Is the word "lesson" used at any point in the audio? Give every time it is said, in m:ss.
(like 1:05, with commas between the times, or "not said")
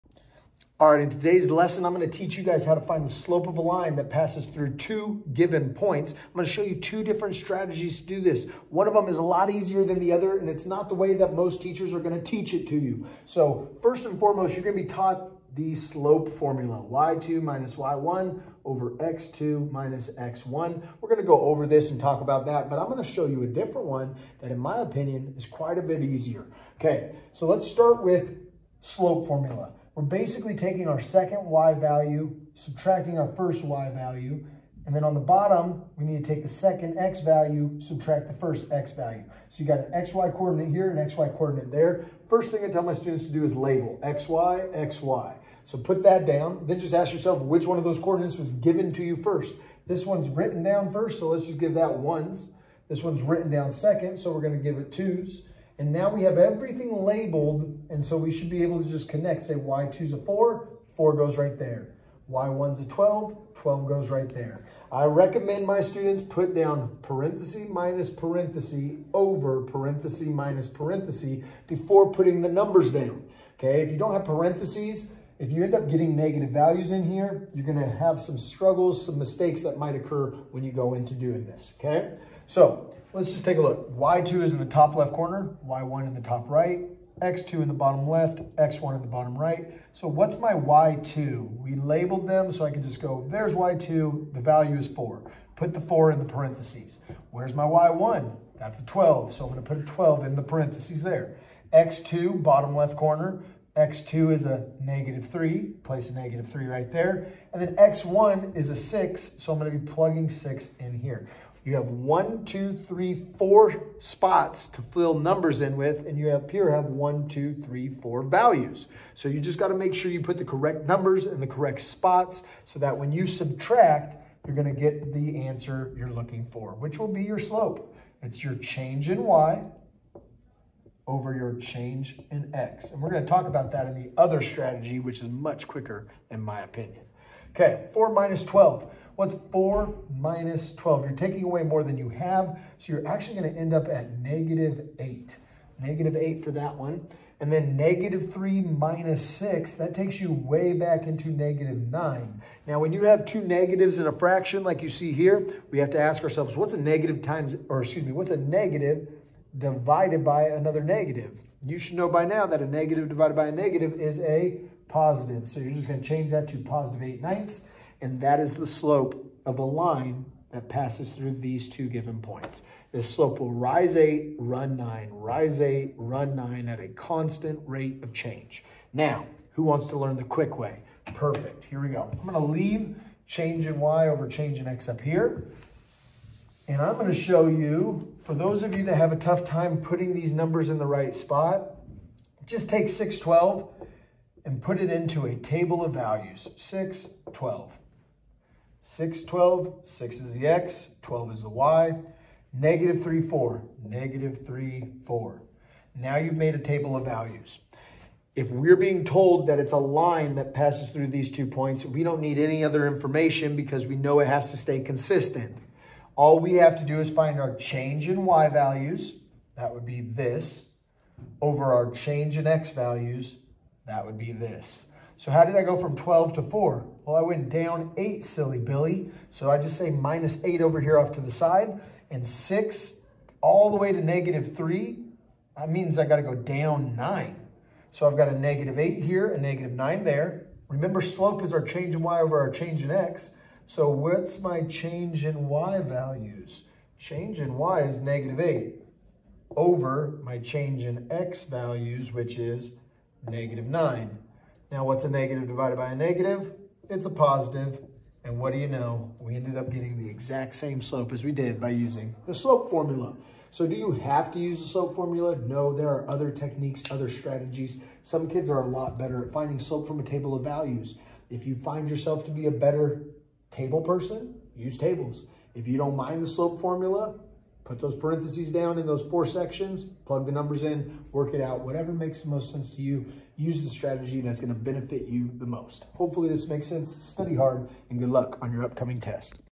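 0:01.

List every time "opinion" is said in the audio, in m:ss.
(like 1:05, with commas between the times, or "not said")
0:24, 2:16.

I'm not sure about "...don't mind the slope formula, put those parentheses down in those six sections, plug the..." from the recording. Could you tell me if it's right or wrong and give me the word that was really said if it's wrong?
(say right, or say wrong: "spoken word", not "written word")
wrong: "four", not "six".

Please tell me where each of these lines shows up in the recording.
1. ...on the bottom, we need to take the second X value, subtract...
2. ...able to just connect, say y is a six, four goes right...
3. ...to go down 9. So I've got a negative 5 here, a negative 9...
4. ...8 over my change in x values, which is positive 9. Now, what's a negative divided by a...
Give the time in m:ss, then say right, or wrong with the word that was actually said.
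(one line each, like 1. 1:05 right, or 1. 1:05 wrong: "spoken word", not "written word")
1. 0:35 right
2. 0:58 wrong: "four", not "six"
3. 3:56 wrong: "8", not "5"
4. 4:08 wrong: "negative", not "positive".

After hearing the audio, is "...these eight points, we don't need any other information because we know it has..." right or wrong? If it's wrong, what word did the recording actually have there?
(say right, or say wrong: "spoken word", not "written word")
wrong: "two", not "eight".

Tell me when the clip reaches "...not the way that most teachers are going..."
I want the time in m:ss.
0:10.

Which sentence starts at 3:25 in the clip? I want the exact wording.
Now you've made a table of values.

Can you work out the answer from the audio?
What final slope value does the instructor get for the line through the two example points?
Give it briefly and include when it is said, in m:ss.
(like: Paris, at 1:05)
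8/9, at 2:46.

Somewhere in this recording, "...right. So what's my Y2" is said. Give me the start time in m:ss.
1:29.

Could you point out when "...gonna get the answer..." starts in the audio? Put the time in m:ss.
2:04.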